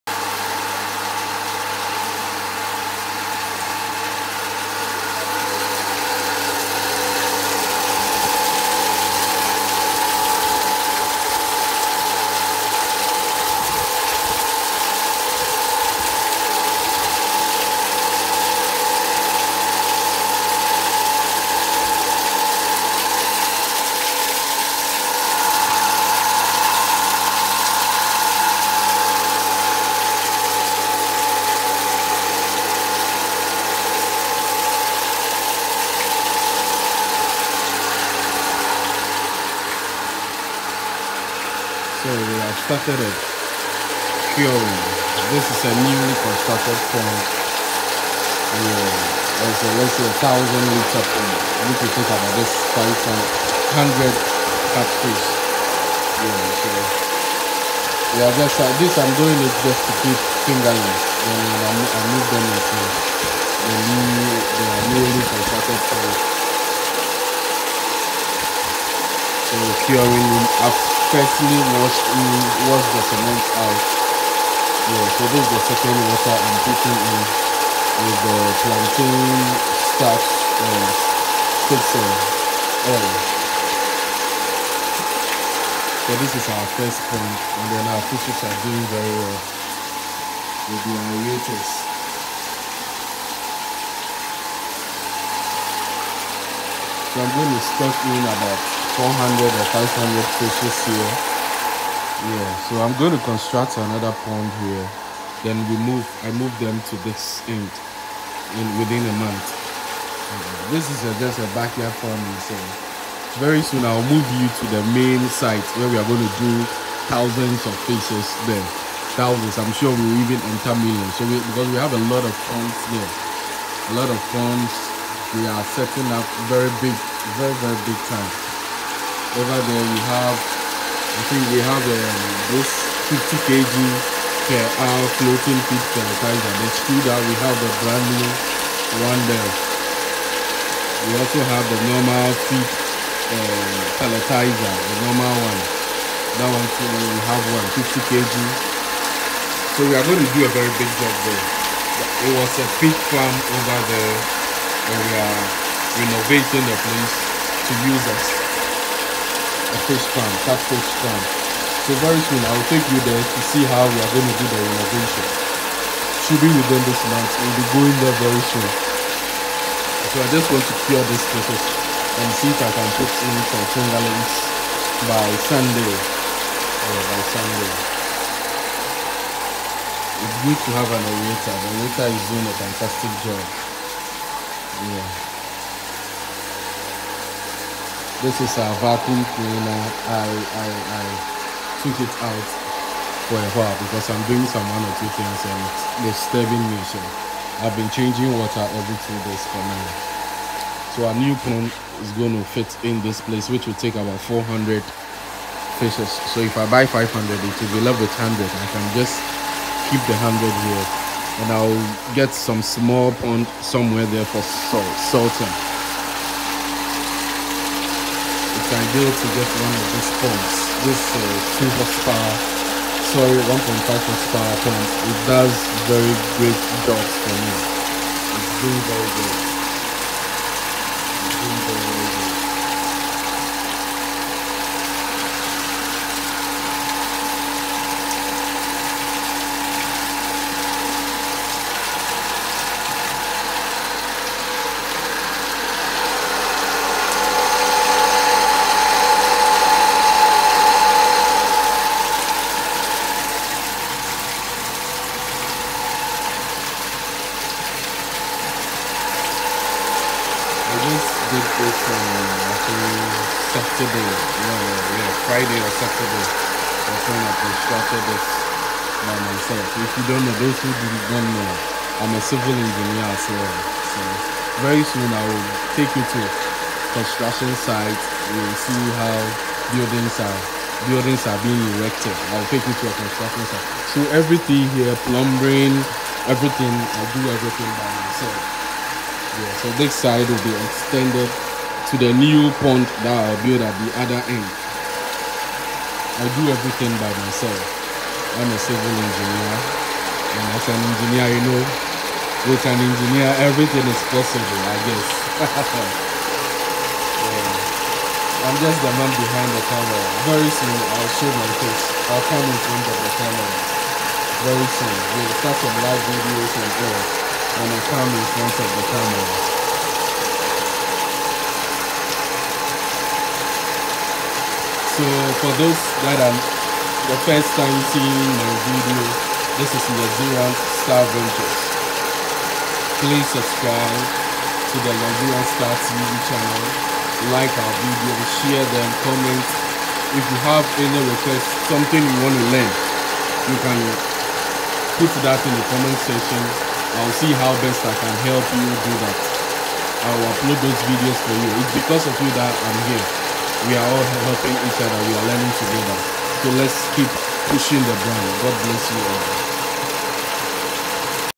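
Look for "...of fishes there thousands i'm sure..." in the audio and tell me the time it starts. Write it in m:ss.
1:57.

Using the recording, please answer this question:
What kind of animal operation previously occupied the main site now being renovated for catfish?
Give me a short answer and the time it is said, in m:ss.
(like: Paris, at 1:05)
pig farm, at 2:32.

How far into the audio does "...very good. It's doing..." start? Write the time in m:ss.
3:48.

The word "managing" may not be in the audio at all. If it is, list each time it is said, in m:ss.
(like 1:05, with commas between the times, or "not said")
not said.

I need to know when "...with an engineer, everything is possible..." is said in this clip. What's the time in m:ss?
5:02.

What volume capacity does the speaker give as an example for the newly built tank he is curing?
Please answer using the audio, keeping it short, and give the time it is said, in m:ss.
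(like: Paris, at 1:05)
1000 liters, at 0:50.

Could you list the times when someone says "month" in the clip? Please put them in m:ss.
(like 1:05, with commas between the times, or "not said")
1:49, 2:47.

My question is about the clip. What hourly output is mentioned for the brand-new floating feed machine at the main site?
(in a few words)
50 kg per hour.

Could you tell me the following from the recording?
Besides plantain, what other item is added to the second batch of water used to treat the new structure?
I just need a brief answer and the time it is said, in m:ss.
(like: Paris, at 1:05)
fixer oil, at 1:21.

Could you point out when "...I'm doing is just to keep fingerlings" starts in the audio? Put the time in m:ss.
0:58.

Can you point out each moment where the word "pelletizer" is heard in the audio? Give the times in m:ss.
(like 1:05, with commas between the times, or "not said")
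2:15, 2:24.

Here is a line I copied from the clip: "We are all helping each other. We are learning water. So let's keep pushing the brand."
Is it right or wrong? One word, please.
wrong.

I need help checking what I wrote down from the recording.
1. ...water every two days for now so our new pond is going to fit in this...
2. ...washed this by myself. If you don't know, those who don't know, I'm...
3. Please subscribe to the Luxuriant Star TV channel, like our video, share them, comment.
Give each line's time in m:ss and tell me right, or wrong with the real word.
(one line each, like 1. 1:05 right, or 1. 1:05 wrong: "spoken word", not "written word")
1. 3:18 right
2. 4:27 wrong: "constructed", not "washed"
3. 5:33 right.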